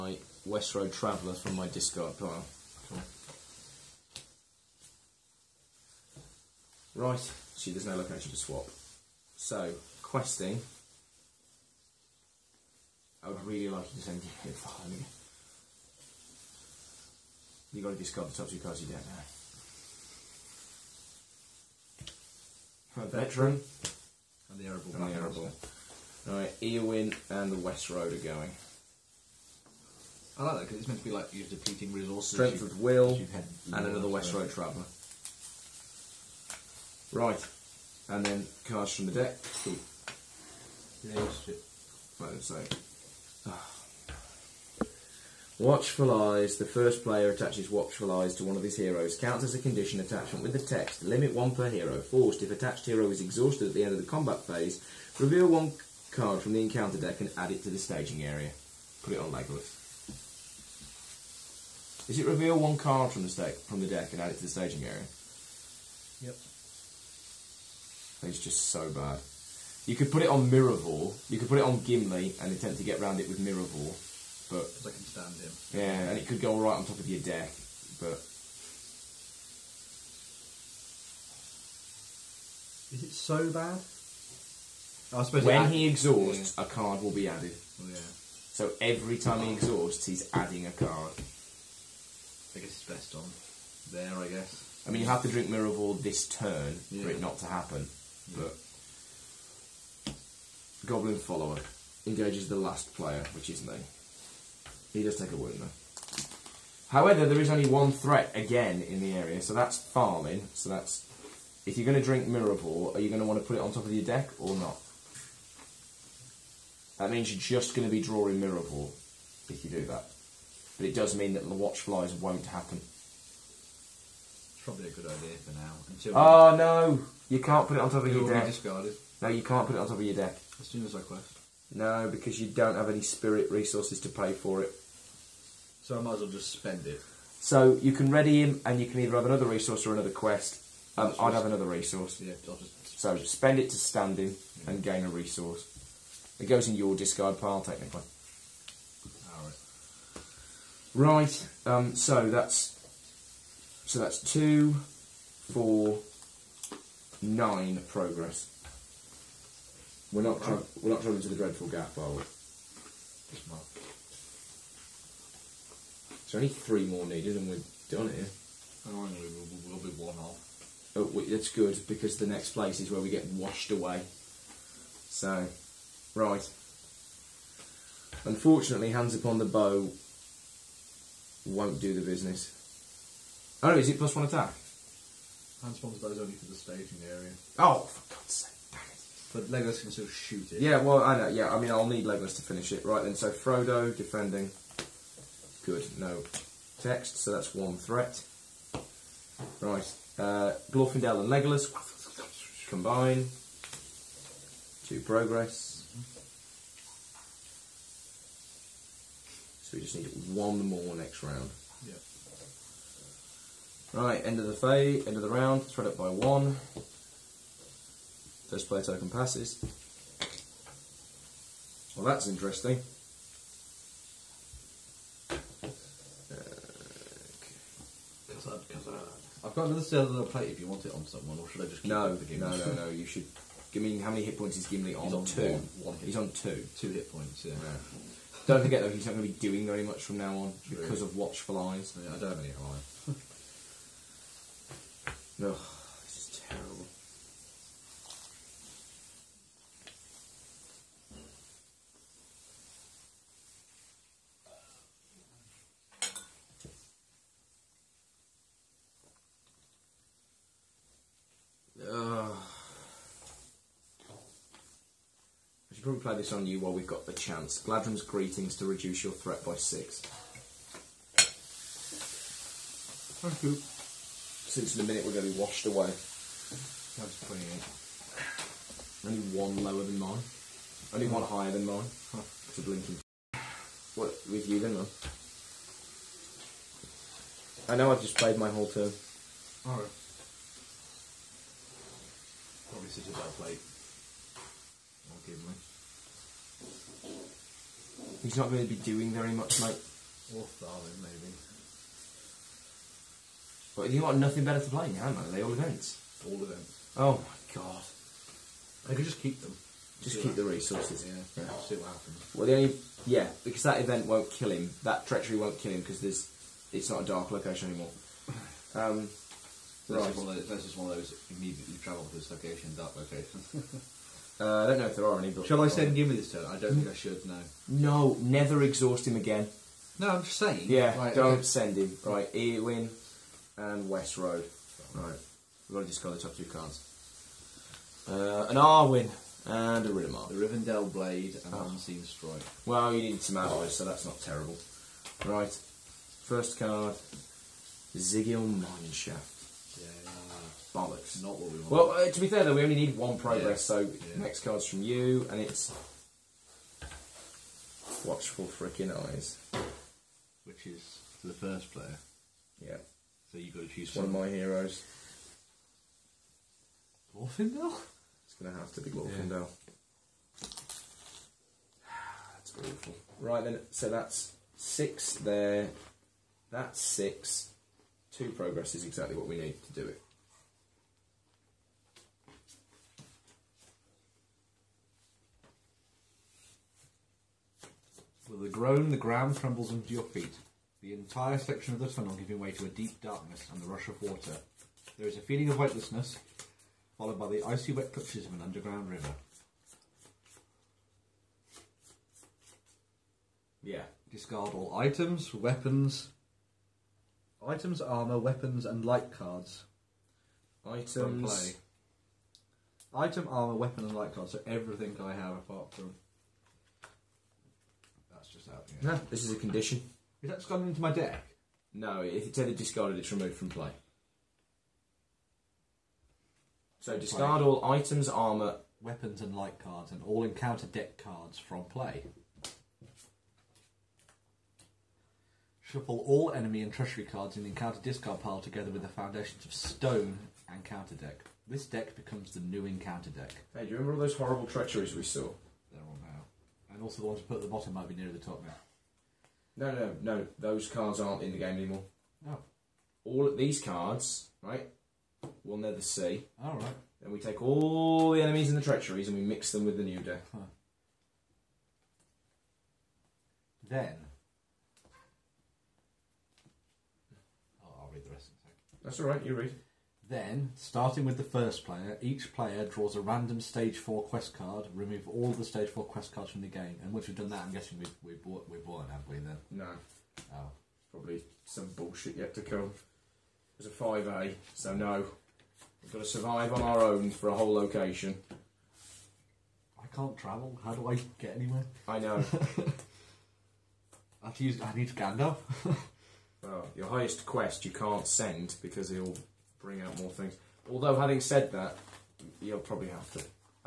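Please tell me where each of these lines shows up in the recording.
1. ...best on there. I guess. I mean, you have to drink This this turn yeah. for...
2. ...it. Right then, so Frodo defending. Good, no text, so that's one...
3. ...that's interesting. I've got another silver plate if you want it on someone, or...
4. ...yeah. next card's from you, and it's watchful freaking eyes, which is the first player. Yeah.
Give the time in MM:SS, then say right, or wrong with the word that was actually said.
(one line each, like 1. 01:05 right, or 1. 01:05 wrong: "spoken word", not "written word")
1. 01:32 wrong: "Miruvor", not "This"
2. 03:12 right
3. 03:42 right
4. 05:53 right.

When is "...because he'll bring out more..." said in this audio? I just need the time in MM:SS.
08:18.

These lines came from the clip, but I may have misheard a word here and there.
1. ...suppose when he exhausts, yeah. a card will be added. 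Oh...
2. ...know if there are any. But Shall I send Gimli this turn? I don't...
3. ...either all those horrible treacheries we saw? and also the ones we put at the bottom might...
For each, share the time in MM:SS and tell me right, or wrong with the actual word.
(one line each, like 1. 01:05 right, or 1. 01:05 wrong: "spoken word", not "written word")
1. 01:25 right
2. 05:24 right
3. 07:23 wrong: "remember", not "either".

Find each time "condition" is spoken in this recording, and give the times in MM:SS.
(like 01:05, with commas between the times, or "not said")
00:49, 06:59.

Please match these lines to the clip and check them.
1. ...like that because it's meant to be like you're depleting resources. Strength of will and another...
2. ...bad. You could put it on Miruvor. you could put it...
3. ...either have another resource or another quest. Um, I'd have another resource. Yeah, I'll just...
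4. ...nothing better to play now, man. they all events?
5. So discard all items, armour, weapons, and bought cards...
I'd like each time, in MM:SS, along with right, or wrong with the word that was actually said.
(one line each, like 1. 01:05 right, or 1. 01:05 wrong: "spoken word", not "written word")
1. 00:30 right
2. 01:08 right
3. 02:19 right
4. 05:04 right
5. 07:06 wrong: "light", not "bought".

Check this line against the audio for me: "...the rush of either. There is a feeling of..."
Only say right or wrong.
wrong.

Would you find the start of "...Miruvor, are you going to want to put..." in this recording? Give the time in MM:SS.
01:52.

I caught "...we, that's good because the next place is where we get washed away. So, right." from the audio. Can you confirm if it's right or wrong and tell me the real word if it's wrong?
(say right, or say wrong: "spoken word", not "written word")
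right.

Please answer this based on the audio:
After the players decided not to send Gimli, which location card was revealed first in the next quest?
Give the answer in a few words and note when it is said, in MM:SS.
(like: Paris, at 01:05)
Zigil Mineshaft, at 05:47.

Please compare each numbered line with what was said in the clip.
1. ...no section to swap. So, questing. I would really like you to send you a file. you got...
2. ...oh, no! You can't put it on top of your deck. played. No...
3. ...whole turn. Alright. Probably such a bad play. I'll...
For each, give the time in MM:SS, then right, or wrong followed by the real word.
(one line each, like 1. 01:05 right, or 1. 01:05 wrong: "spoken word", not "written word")
1. 00:07 wrong: "location", not "section"
2. 02:06 wrong: "discarded", not "played"
3. 04:48 right.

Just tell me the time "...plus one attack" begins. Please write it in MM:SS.
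03:03.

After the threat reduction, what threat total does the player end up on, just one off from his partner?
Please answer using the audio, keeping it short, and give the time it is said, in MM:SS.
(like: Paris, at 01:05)
28, at 04:37.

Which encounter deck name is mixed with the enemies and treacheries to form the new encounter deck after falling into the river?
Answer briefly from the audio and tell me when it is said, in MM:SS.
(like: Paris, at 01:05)
Foundations of Stone, at 07:18.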